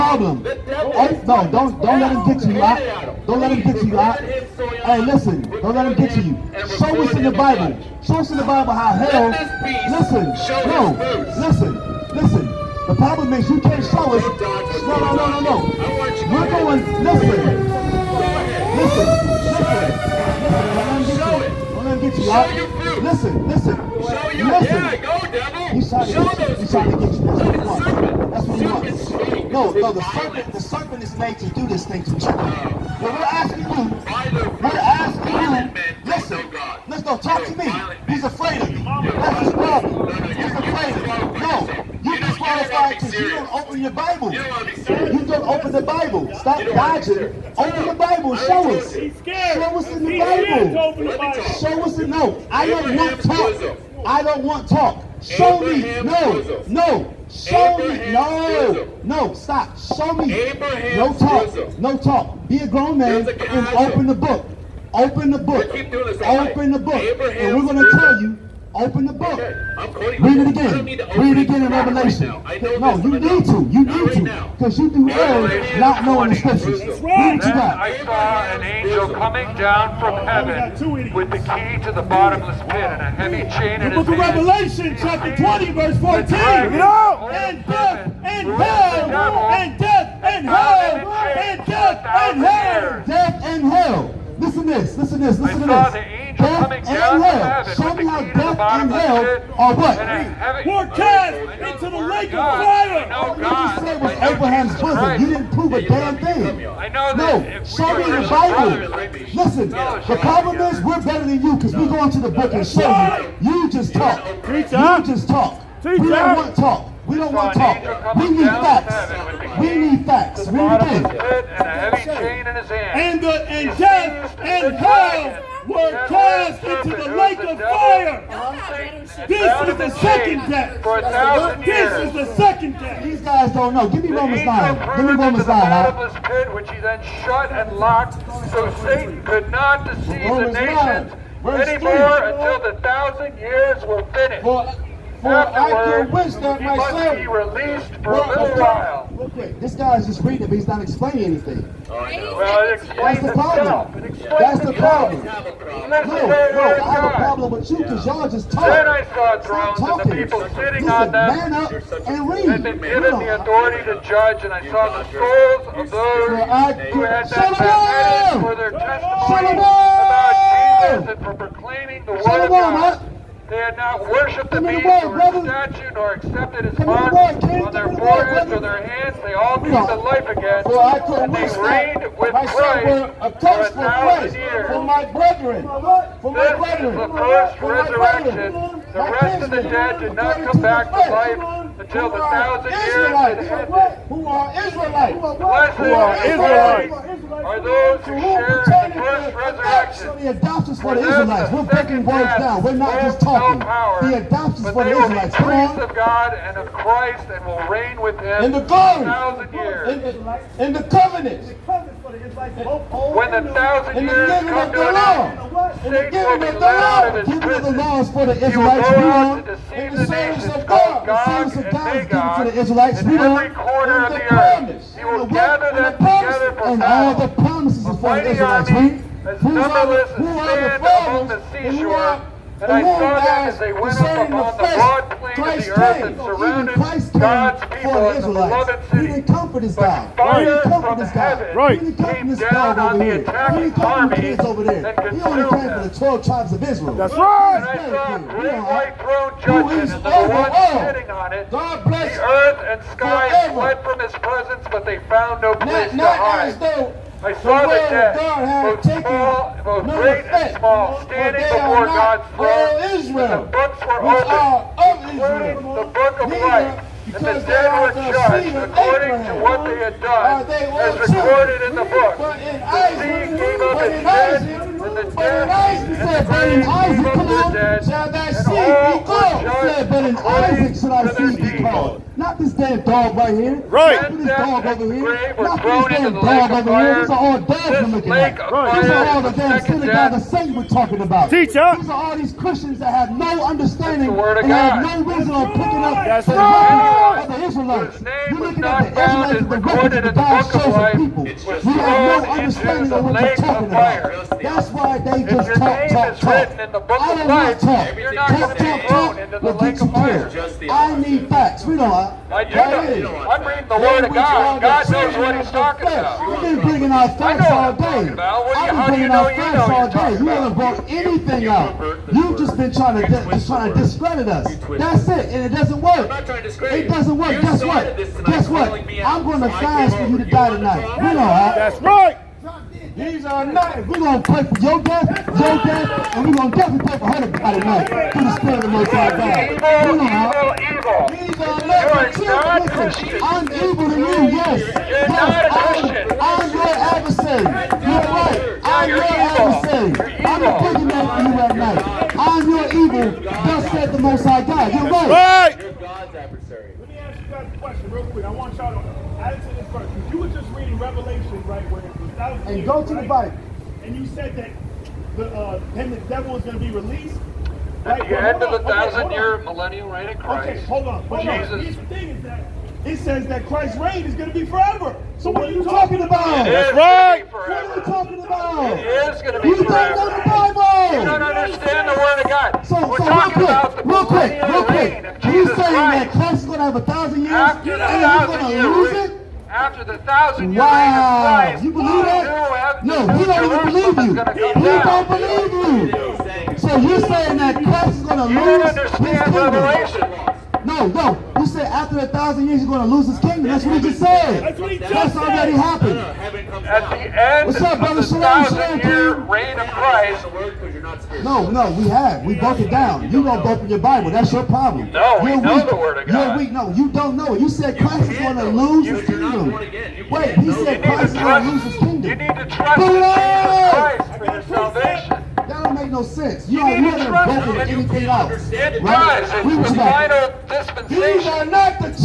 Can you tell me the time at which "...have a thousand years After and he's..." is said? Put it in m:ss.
6:26.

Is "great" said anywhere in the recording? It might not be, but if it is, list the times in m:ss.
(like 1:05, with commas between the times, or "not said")
4:08, 4:20.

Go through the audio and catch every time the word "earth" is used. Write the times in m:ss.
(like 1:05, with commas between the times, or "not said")
3:55, 4:12.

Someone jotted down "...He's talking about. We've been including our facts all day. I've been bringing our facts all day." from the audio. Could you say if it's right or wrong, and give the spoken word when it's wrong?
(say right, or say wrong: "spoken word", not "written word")
wrong: "bringing", not "including".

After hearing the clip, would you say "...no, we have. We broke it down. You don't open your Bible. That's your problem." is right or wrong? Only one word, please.
right.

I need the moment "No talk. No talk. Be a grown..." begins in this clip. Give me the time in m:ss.
1:00.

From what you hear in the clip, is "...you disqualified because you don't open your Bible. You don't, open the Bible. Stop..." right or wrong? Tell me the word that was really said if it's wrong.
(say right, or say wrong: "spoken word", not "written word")
right.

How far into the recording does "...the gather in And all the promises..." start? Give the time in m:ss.
3:45.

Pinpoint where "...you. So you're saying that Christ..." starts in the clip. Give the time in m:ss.
6:36.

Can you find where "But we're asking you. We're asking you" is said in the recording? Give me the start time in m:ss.
0:33.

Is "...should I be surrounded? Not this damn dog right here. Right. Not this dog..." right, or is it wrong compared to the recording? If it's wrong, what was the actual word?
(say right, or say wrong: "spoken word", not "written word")
wrong: "called", not "surrounded".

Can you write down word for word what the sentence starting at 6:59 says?
Wait, he said Christ is going to lose his kingdom.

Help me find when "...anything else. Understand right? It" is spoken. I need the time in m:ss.
7:07.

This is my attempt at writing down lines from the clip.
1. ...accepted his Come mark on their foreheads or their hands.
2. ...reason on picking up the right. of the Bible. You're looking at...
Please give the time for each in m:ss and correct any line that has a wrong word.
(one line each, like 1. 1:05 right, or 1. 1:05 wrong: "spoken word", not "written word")
1. 2:56 right
2. 4:55 wrong: "Israelites", not "Bible".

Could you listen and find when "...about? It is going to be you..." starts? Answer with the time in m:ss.
6:18.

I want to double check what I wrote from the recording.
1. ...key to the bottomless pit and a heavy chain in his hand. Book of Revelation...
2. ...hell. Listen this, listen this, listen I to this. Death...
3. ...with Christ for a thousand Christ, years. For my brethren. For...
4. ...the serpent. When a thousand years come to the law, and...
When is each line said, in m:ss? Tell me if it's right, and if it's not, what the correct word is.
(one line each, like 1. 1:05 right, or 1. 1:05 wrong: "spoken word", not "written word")
1. 1:21 right
2. 1:33 right
3. 3:02 right
4. 3:30 wrong: "covenant", not "serpent".